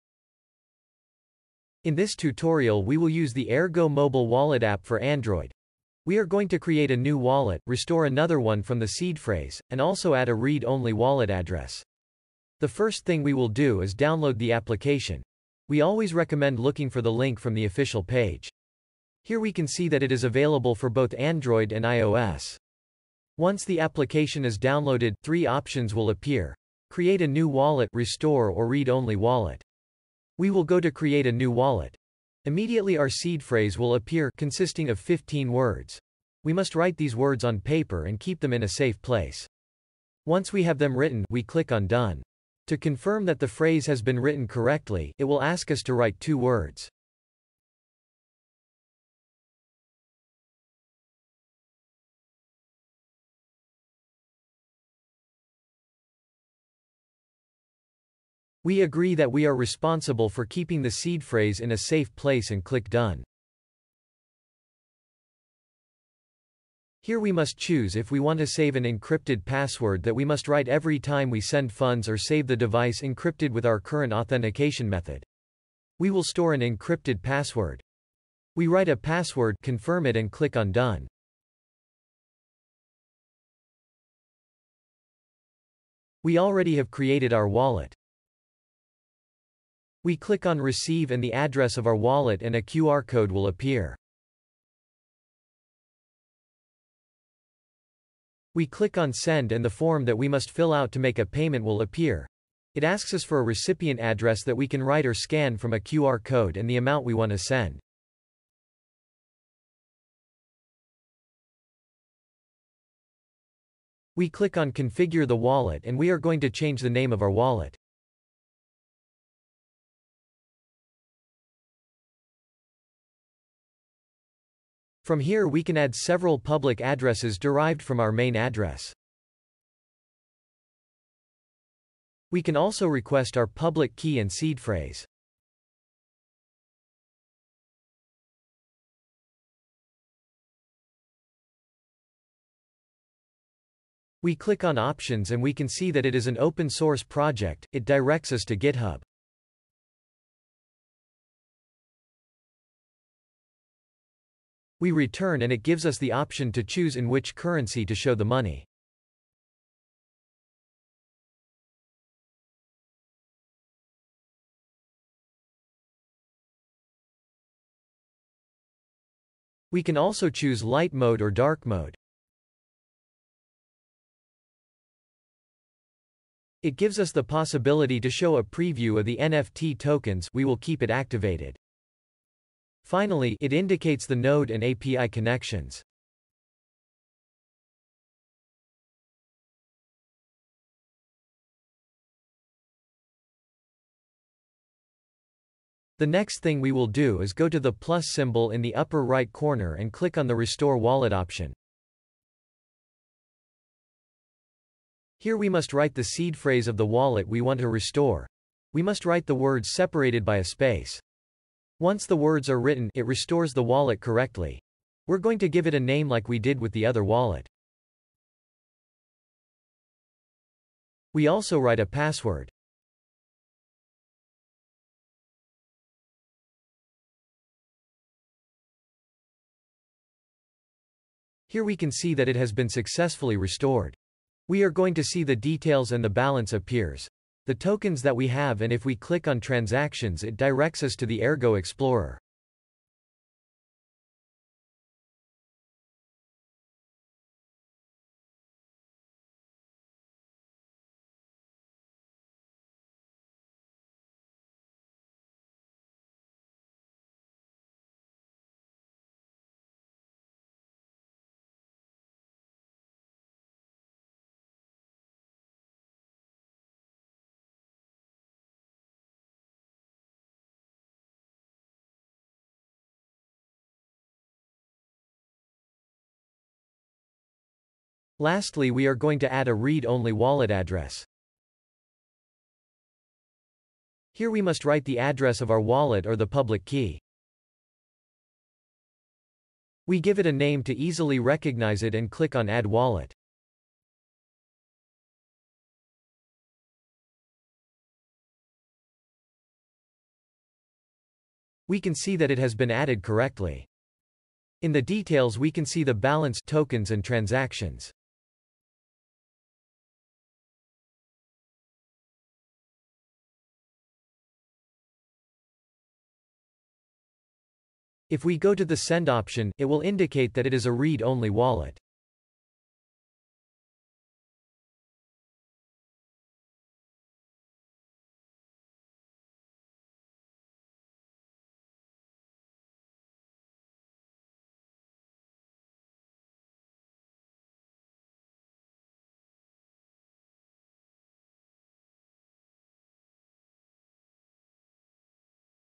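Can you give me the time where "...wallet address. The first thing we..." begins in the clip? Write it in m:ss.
0:10.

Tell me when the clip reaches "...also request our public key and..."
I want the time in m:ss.
2:12.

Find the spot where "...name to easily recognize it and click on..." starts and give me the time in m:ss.
4:50.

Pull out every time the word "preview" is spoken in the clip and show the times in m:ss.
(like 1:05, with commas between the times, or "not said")
2:58.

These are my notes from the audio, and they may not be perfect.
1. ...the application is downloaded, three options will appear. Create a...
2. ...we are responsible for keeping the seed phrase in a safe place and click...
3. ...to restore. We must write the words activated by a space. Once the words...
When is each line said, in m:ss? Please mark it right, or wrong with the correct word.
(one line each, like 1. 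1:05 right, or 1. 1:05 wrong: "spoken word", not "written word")
1. 0:23 right
2. 0:59 right
3. 3:27 wrong: "separated", not "activated".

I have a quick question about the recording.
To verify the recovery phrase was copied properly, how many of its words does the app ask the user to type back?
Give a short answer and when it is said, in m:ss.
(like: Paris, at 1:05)
2, at 0:46.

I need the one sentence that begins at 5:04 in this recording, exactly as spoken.
In the details we can see the balance tokens and transactions.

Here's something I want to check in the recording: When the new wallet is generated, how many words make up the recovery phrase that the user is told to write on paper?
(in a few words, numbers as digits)
15.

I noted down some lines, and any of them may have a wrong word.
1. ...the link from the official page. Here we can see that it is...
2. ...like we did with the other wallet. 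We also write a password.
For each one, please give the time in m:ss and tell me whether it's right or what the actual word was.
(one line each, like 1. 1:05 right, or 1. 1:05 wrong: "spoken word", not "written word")
1. 0:17 right
2. 3:36 right.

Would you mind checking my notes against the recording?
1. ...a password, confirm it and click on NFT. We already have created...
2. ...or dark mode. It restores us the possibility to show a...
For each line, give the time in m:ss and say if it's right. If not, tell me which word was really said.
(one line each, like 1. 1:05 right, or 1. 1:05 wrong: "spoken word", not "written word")
1. 1:18 wrong: "Done", not "NFT"
2. 2:51 wrong: "gives", not "restores".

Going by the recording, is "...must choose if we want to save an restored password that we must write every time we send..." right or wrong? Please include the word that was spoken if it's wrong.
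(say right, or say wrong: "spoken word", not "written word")
wrong: "encrypted", not "restored".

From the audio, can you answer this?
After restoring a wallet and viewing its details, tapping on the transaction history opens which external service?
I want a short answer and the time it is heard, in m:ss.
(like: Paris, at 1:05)
Ergo Explorer, at 4:01.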